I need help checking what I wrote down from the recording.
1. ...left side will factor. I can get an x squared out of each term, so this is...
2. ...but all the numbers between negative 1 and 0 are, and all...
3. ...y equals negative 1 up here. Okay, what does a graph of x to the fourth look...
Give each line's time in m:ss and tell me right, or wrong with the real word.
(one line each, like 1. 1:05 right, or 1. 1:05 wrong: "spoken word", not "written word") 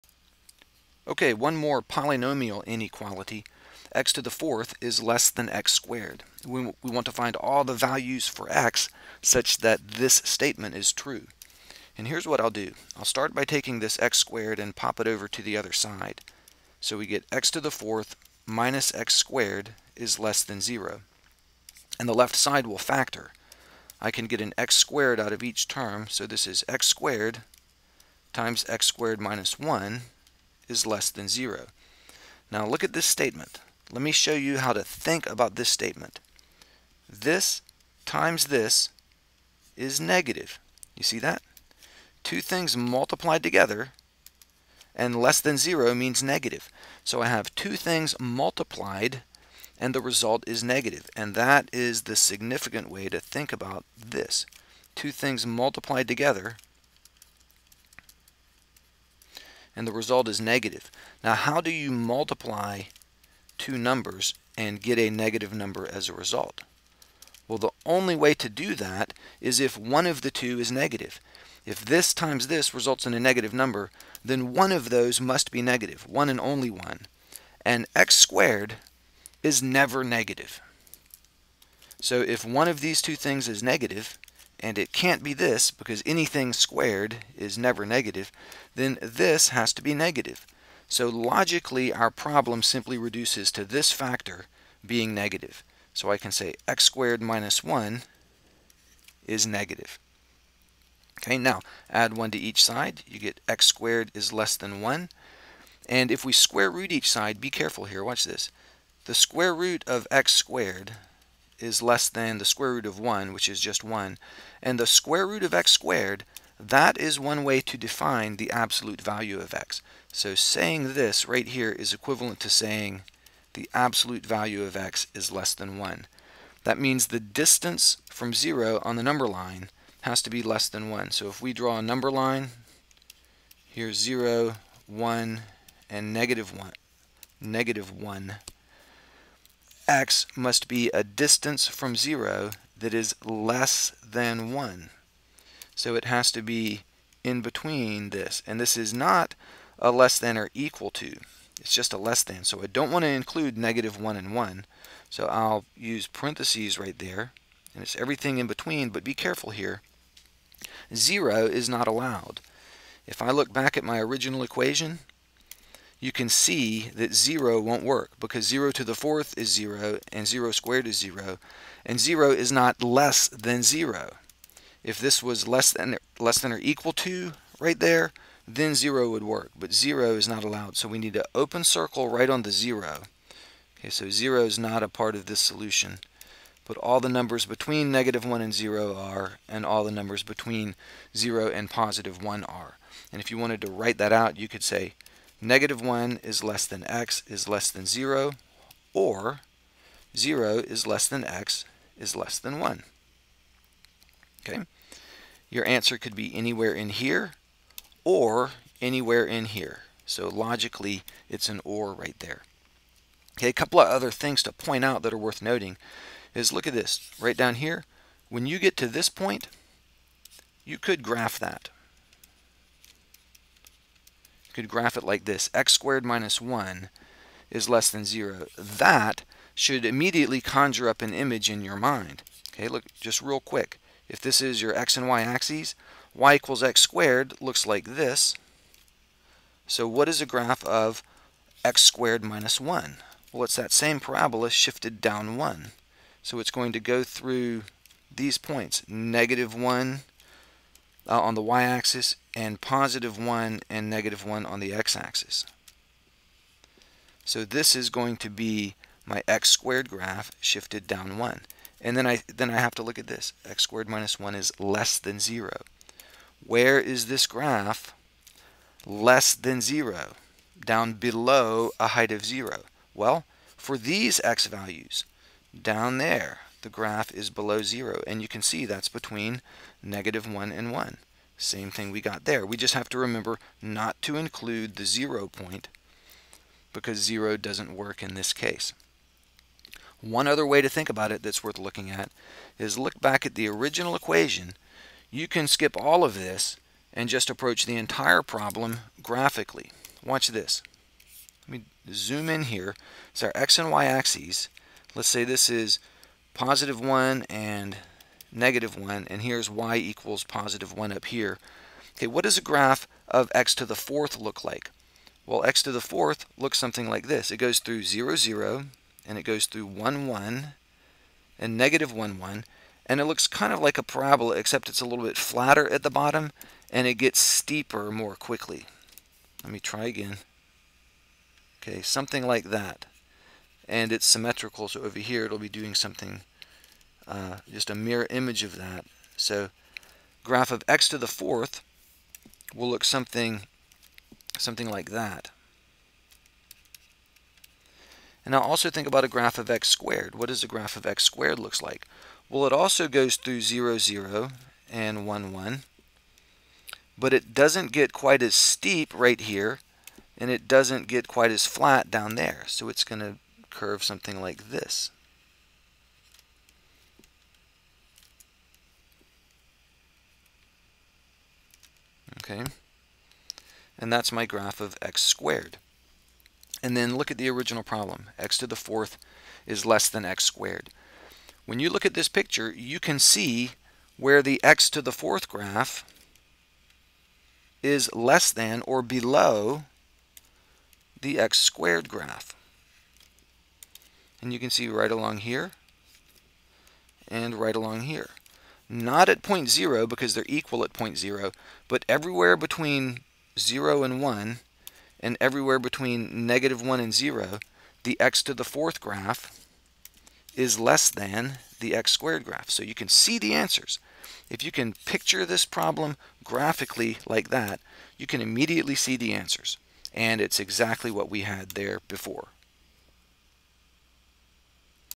1. 0:22 right
2. 3:06 right
3. 5:09 wrong: "positive", not "negative".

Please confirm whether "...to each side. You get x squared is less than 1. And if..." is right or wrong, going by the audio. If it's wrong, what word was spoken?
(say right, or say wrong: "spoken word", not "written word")
right.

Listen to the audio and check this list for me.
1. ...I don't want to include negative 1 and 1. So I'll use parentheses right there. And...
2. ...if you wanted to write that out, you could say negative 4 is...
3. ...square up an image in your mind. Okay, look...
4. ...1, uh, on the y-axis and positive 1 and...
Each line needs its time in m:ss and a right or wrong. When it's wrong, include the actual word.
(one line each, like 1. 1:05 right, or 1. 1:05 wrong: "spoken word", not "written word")
1. 2:32 right
2. 3:13 wrong: "1", not "4"
3. 3:50 wrong: "conjure", not "square"
4. 4:09 right.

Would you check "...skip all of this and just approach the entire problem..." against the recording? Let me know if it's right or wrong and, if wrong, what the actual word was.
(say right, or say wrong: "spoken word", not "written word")
right.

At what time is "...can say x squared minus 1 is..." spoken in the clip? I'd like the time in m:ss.
1:36.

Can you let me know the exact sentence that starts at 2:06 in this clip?
That means the distance from 0 on the number line has to be less than 1.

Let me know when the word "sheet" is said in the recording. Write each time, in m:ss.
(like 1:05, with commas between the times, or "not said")
not said.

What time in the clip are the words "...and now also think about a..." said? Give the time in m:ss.
5:48.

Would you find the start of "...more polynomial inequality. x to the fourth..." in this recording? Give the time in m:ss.
0:01.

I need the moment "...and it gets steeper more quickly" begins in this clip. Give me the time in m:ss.
5:26.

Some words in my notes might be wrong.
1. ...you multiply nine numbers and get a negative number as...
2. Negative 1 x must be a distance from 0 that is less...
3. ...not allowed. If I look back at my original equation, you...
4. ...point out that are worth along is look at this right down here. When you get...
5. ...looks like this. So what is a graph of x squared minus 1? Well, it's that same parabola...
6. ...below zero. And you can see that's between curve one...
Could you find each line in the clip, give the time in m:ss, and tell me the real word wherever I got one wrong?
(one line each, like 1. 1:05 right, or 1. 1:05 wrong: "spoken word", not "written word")
1. 1:01 wrong: "two", not "nine"
2. 2:17 right
3. 2:41 right
4. 3:34 wrong: "noting", not "along"
5. 3:57 right
6. 4:37 wrong: "negative", not "curve".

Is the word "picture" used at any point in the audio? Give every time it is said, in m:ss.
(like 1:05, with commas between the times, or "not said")
6:22, 6:54.